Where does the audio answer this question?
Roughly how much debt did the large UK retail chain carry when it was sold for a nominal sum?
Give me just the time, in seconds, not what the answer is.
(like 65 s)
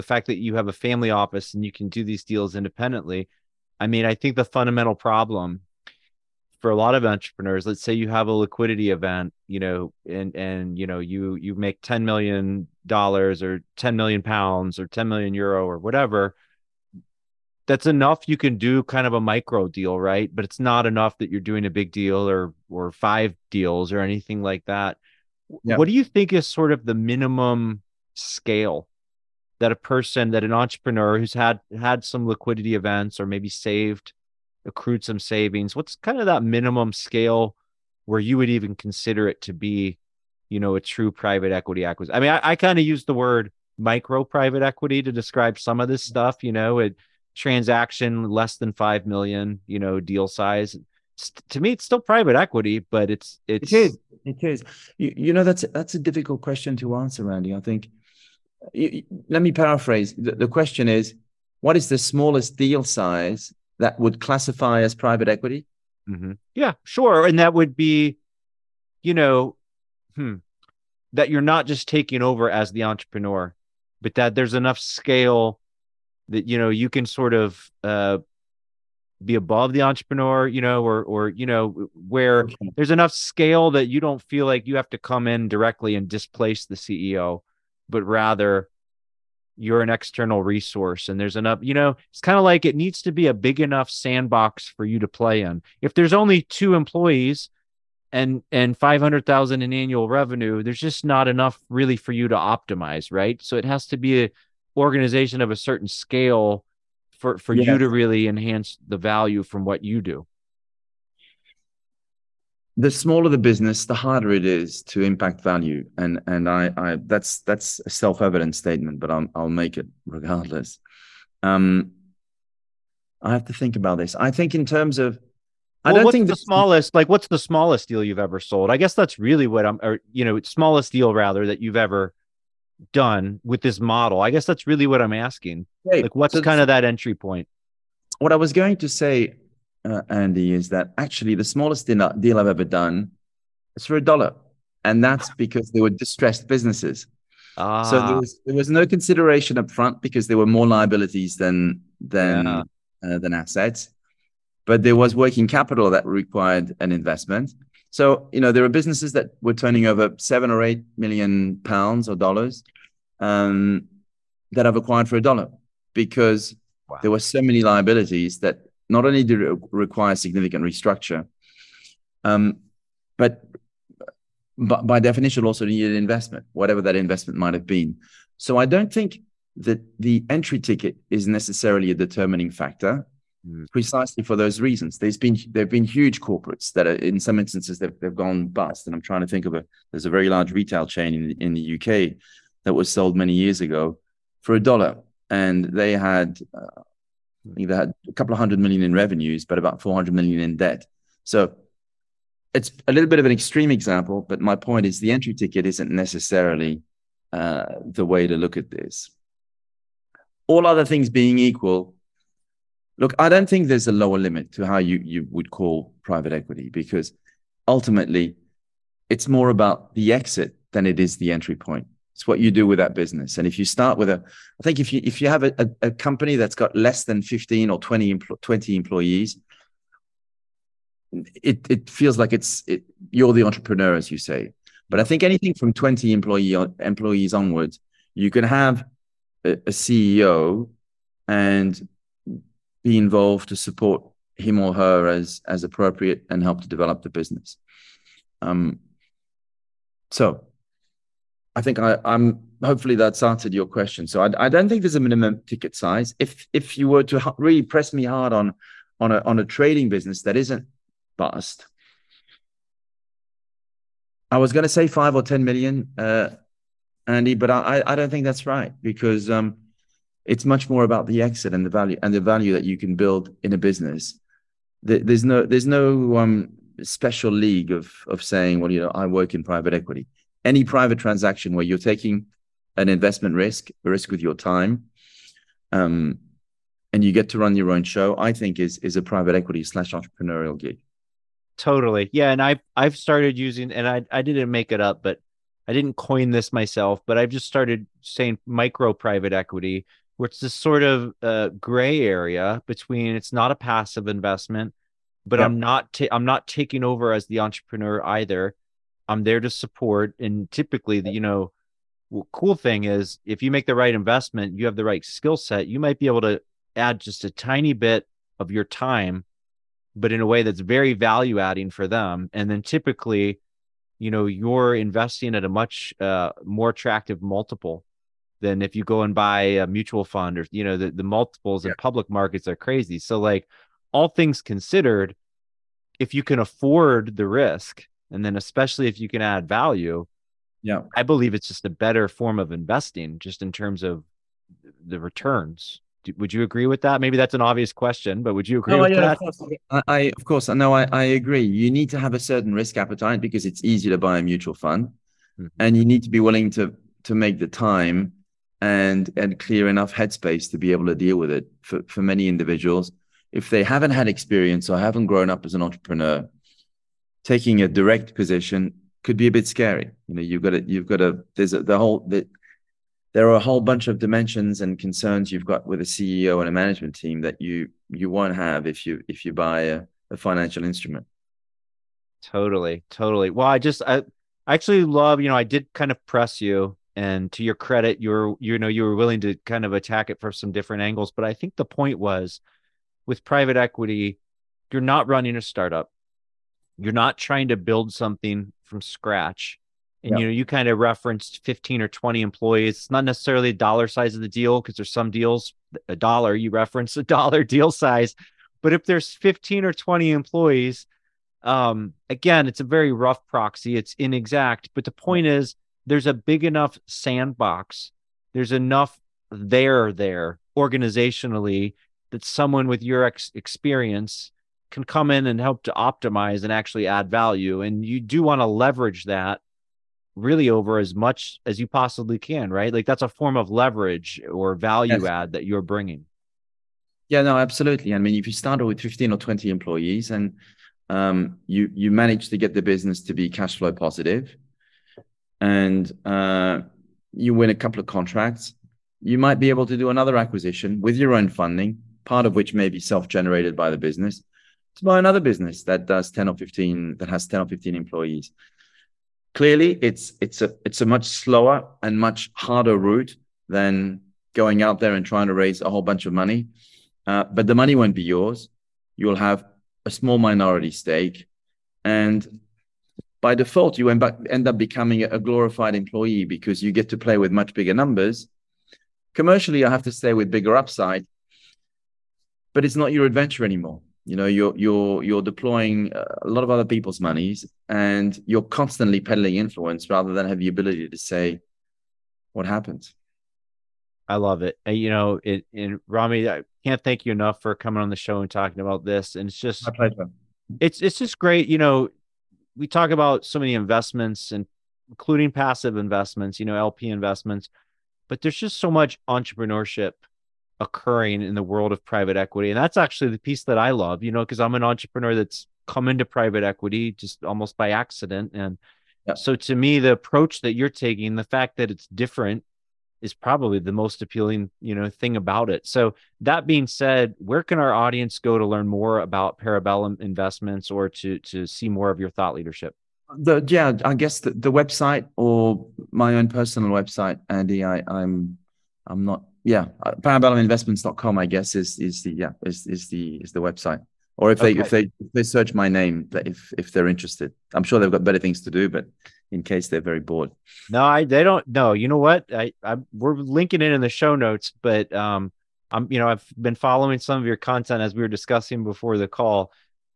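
199 s.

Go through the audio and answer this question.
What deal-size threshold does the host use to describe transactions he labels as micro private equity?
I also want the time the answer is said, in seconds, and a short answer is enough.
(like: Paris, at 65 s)
less than 5 million, at 48 s.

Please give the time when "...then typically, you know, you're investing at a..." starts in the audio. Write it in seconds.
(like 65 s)
322 s.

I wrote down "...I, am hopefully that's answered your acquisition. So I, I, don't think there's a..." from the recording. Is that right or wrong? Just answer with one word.
wrong.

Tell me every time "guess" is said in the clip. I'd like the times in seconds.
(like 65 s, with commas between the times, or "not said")
128 s, 134 s, 533 s, 541 s.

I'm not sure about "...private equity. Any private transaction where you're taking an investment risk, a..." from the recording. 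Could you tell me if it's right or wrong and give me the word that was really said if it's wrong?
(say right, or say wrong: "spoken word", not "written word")
right.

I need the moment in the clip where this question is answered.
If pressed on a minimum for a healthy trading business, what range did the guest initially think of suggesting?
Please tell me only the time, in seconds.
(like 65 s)
264 s.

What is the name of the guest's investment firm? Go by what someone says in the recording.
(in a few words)
Parabellum Investments.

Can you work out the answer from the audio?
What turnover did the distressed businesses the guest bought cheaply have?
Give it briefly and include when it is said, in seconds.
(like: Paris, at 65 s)
7 or 8 million, at 160 s.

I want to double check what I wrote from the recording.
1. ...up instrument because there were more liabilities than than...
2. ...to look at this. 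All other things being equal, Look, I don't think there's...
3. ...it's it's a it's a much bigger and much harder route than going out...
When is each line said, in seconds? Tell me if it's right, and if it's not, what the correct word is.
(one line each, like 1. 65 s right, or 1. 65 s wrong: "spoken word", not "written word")
1. 149 s wrong: "front", not "instrument"
2. 208 s right
3. 459 s wrong: "slower", not "bigger".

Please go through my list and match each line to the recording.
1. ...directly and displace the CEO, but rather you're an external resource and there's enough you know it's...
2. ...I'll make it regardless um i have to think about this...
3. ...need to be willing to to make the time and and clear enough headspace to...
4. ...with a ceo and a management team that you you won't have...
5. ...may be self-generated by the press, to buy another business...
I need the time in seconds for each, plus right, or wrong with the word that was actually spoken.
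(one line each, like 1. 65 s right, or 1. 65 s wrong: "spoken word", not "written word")
1. 85 s right
2. 119 s right
3. 355 s right
4. 375 s right
5. 452 s wrong: "business", not "press".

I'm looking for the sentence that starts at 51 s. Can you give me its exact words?
to me it's still private equity, but it's it's It is.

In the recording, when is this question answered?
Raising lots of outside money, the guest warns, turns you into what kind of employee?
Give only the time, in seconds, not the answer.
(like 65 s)
475 s.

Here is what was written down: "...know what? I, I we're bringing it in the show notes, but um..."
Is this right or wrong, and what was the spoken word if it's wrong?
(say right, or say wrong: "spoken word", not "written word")
wrong: "linking", not "bringing".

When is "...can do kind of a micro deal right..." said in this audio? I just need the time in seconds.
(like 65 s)
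18 s.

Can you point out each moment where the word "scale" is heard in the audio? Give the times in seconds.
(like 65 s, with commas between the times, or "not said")
28 s, 36 s, 74 s, 83 s, 105 s.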